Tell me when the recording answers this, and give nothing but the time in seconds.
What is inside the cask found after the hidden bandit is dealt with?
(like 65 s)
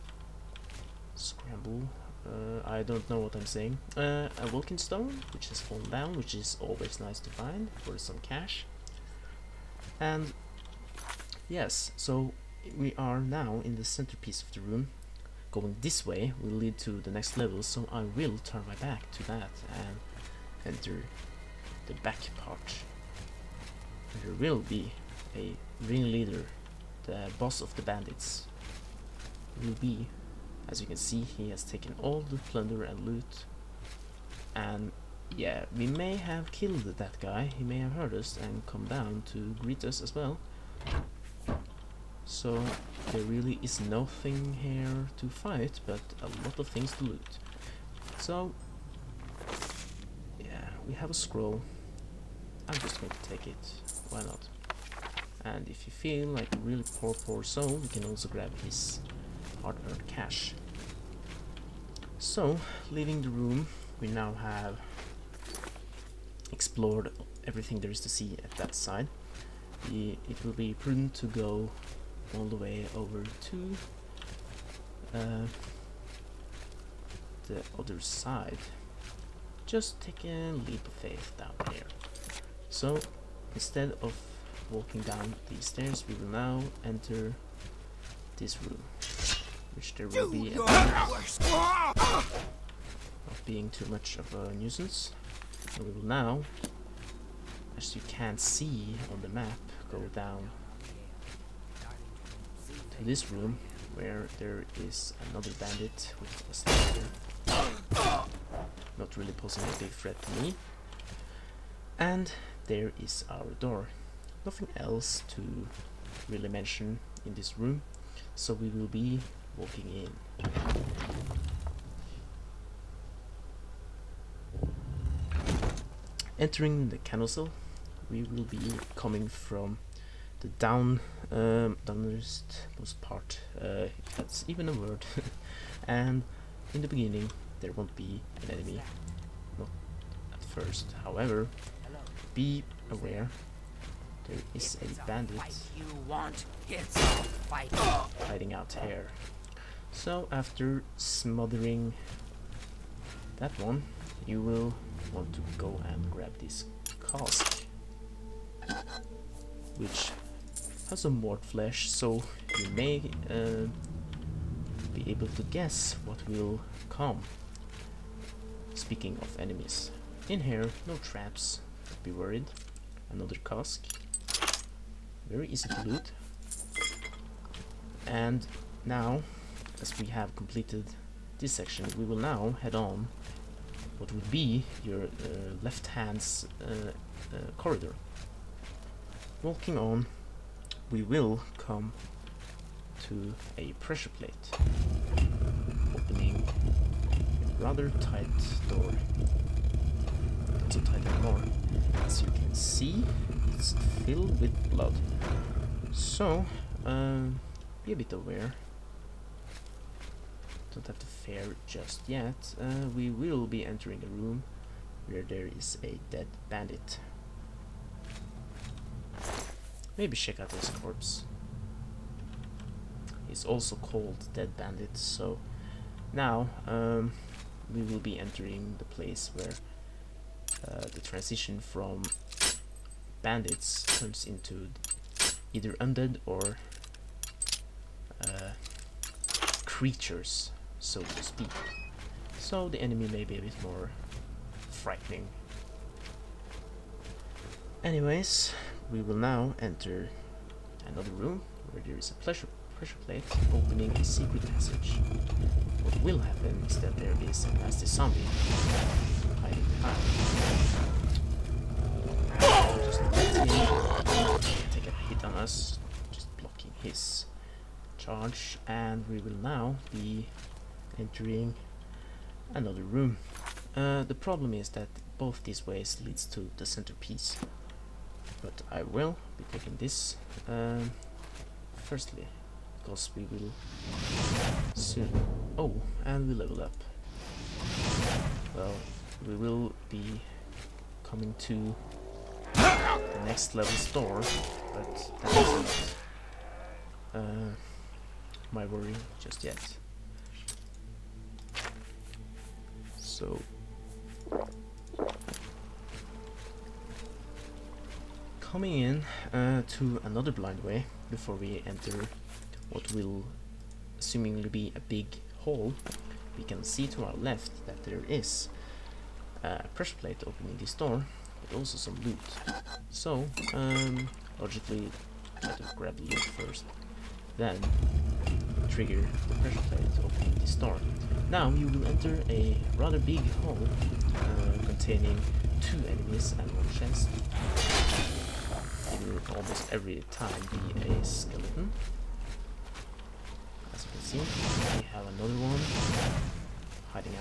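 161 s.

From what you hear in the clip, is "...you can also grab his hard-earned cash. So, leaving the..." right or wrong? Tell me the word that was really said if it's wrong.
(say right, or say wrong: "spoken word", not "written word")
right.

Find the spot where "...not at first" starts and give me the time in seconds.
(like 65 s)
139 s.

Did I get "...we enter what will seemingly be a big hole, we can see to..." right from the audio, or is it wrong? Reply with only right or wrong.
right.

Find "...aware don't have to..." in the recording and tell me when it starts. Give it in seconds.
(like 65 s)
208 s.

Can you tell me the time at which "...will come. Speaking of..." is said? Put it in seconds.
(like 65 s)
166 s.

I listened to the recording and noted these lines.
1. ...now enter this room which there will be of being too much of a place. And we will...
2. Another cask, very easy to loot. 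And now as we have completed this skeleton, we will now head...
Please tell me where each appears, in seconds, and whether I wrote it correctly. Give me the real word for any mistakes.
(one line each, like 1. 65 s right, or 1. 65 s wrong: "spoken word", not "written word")
1. 86 s wrong: "nuisance", not "place"
2. 173 s wrong: "section", not "skeleton".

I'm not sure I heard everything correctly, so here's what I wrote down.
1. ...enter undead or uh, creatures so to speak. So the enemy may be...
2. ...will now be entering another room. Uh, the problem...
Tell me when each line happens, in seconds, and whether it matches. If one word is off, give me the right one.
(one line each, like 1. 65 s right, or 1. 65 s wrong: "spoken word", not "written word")
1. 235 s wrong: "either", not "enter"
2. 269 s right.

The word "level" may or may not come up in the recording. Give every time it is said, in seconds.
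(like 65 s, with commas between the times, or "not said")
17 s, 286 s, 293 s.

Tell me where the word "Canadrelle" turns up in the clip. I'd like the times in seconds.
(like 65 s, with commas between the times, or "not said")
126 s.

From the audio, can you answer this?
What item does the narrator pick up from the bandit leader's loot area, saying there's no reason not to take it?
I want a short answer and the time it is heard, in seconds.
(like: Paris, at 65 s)
A scroll, at 51 s.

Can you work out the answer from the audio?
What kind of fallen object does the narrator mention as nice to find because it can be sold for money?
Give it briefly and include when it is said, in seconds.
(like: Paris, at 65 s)
Welkynd stone, at 4 s.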